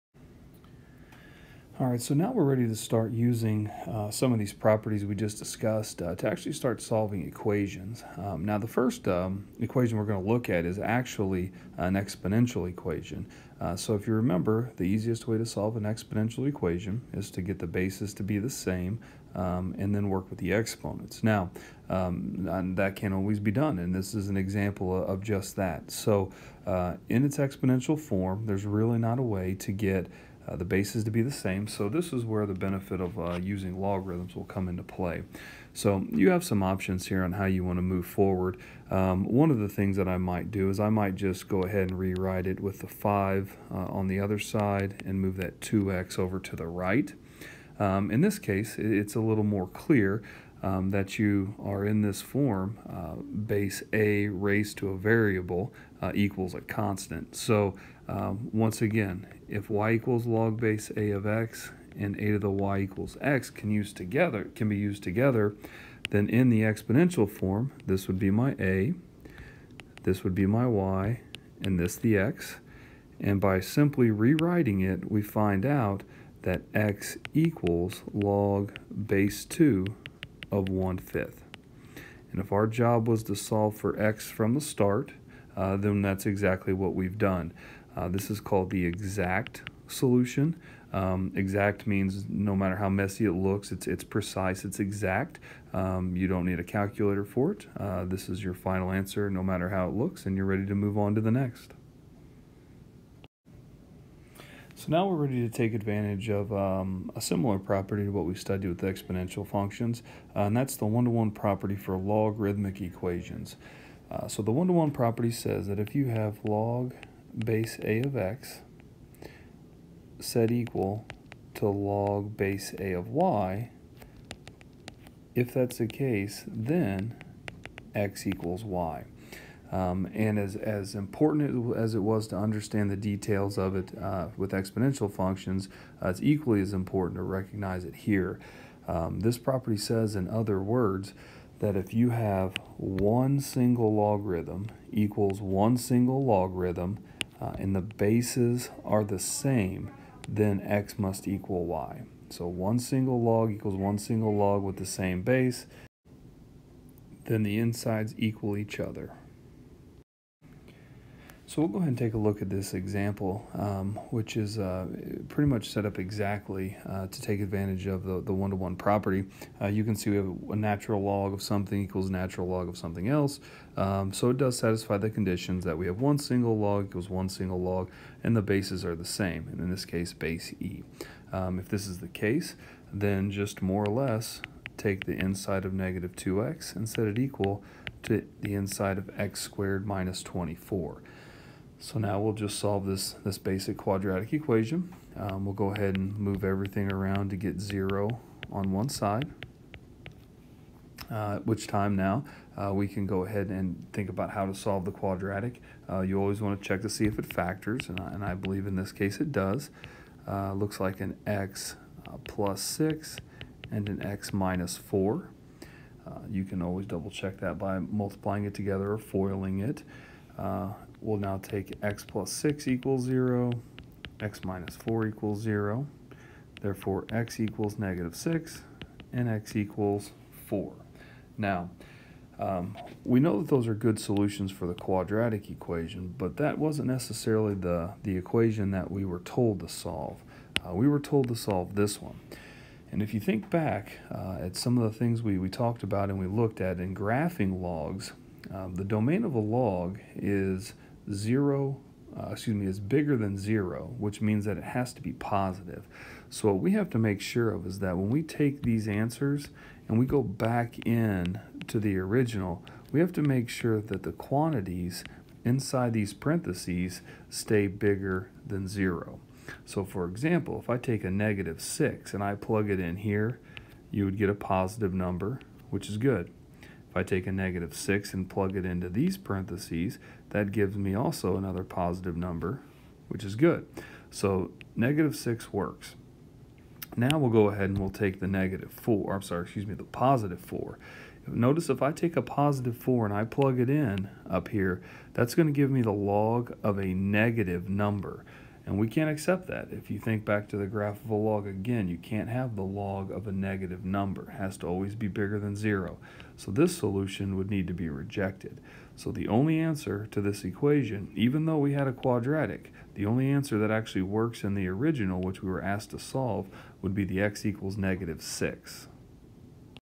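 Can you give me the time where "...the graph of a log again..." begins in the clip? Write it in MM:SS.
05:00.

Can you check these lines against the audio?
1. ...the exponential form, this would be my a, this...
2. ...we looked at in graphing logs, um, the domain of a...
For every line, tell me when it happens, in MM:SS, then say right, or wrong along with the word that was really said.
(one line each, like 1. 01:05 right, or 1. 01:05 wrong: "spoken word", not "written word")
1. 01:06 right
2. 04:06 right.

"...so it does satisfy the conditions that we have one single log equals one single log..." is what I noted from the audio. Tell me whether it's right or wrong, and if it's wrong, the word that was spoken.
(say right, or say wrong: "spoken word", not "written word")
right.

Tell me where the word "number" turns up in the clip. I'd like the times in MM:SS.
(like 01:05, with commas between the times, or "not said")
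04:34, 04:42, 04:57, 05:03.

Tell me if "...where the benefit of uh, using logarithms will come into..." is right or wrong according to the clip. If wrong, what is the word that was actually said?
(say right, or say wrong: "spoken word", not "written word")
right.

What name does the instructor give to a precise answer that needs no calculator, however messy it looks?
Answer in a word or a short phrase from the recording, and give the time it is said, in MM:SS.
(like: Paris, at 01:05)
exact solution, at 01:28.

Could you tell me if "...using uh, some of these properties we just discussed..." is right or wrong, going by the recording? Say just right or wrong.
right.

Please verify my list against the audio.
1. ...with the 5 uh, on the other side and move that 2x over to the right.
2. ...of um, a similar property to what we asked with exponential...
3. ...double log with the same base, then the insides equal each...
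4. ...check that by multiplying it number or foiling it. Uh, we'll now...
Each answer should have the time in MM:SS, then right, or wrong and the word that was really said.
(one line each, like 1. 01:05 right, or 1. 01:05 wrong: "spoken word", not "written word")
1. 00:42 right
2. 01:46 wrong: "studied", not "asked"
3. 02:33 wrong: "single", not "double"
4. 03:37 wrong: "together", not "number".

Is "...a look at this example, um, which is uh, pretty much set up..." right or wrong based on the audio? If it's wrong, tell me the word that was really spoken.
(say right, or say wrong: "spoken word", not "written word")
right.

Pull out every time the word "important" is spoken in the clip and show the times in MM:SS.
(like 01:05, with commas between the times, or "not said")
02:10, 02:16.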